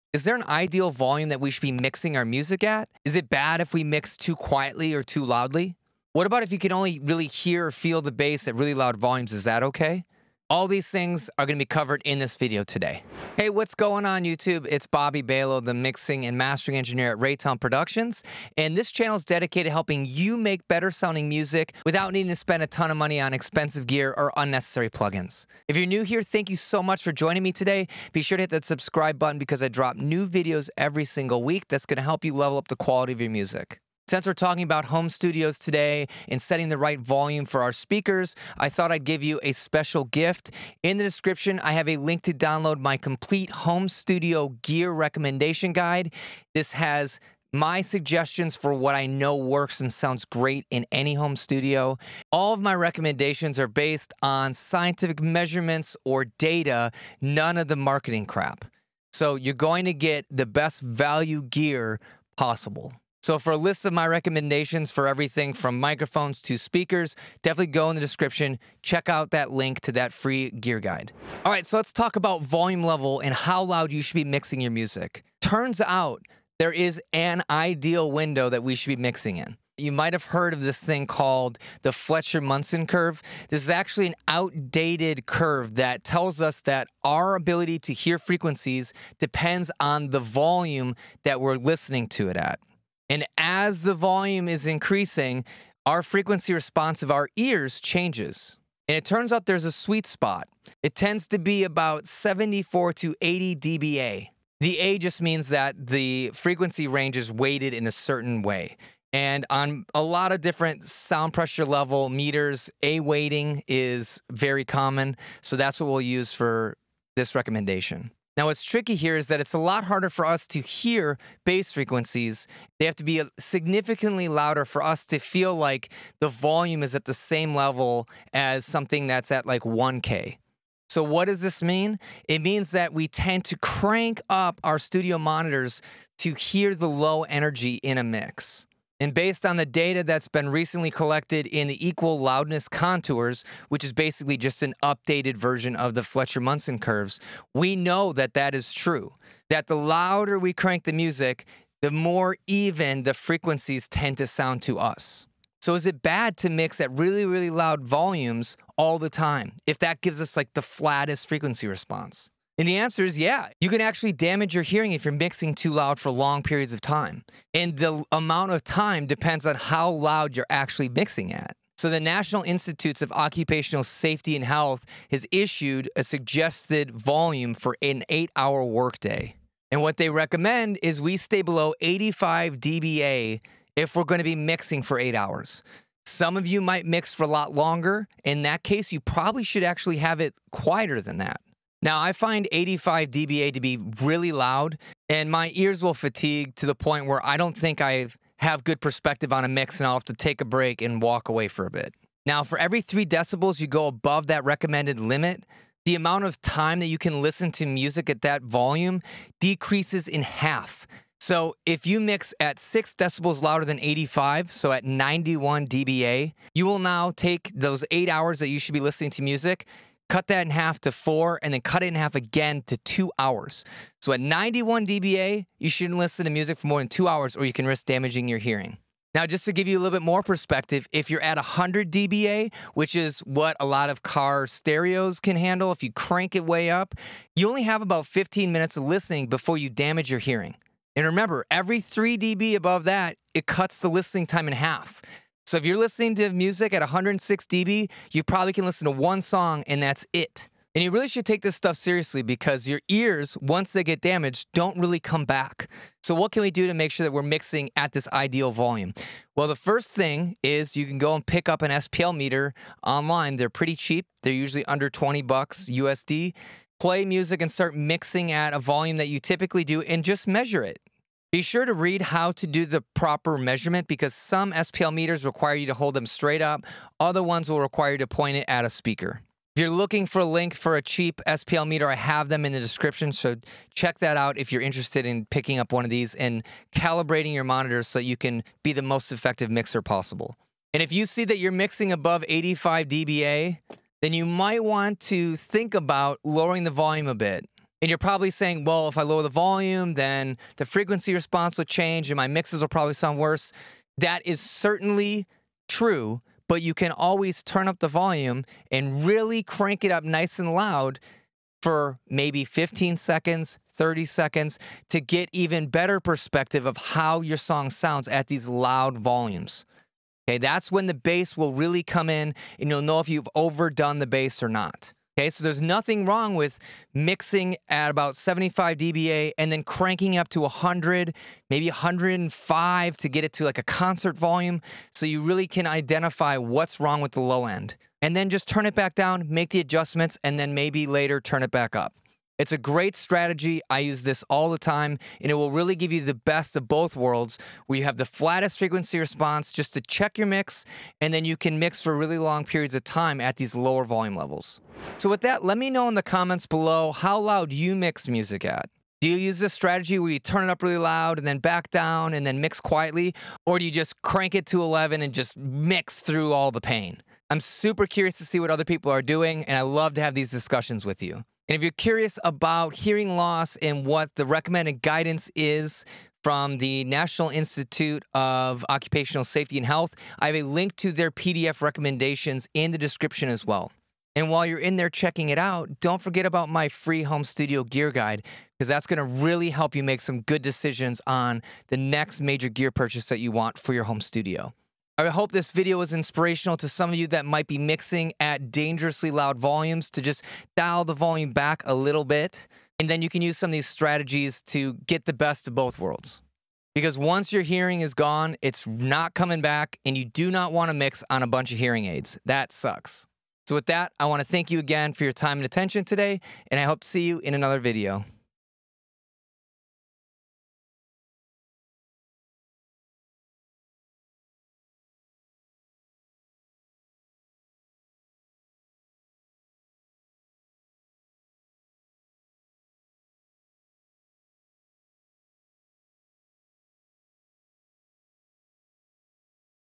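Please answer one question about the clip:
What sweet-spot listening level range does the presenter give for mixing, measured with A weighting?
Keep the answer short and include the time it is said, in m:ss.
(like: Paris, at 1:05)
74 to 80 dBA, at 1:42.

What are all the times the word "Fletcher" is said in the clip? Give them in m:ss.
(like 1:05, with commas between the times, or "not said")
1:21, 2:26.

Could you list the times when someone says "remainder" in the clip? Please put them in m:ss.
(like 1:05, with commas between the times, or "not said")
not said.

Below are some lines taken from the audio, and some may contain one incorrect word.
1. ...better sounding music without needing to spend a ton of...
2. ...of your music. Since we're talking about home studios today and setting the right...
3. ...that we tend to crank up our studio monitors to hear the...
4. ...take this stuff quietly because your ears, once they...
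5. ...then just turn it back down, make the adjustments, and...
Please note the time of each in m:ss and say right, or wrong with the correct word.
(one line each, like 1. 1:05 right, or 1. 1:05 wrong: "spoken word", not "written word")
1. 0:20 right
2. 0:33 right
3. 2:12 right
4. 4:11 wrong: "seriously", not "quietly"
5. 5:38 right.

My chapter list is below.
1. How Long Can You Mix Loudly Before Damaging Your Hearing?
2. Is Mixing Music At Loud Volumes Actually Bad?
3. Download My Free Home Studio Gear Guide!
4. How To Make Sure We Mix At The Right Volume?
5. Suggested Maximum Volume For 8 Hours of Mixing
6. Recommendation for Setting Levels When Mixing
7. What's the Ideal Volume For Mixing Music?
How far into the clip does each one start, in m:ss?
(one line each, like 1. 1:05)
1. 3:22
2. 2:35
3. 0:33
4. 4:15
5. 2:51
6. 4:57
7. 1:11.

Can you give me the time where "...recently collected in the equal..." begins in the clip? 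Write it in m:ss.
2:20.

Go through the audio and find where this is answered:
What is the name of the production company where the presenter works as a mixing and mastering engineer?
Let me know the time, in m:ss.
0:17.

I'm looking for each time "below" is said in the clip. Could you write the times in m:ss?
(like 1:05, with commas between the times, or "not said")
3:01, 5:56.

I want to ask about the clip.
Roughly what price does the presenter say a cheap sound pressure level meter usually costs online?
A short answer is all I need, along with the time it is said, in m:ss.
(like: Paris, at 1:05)
under $20, at 4:24.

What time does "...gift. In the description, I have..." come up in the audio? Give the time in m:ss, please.
0:40.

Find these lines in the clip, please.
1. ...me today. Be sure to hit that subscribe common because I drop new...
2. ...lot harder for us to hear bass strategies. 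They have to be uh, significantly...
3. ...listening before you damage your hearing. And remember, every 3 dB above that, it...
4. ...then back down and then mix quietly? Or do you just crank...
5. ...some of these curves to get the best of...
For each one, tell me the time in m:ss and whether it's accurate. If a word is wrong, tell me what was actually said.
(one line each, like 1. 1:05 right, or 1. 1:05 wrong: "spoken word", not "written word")
1. 0:27 wrong: "button", not "common"
2. 1:59 wrong: "frequencies", not "strategies"
3. 3:58 right
4. 6:01 right
5. 6:43 wrong: "strategies", not "curves".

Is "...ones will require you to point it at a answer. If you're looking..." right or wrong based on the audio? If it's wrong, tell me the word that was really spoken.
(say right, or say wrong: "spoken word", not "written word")
wrong: "speaker", not "answer".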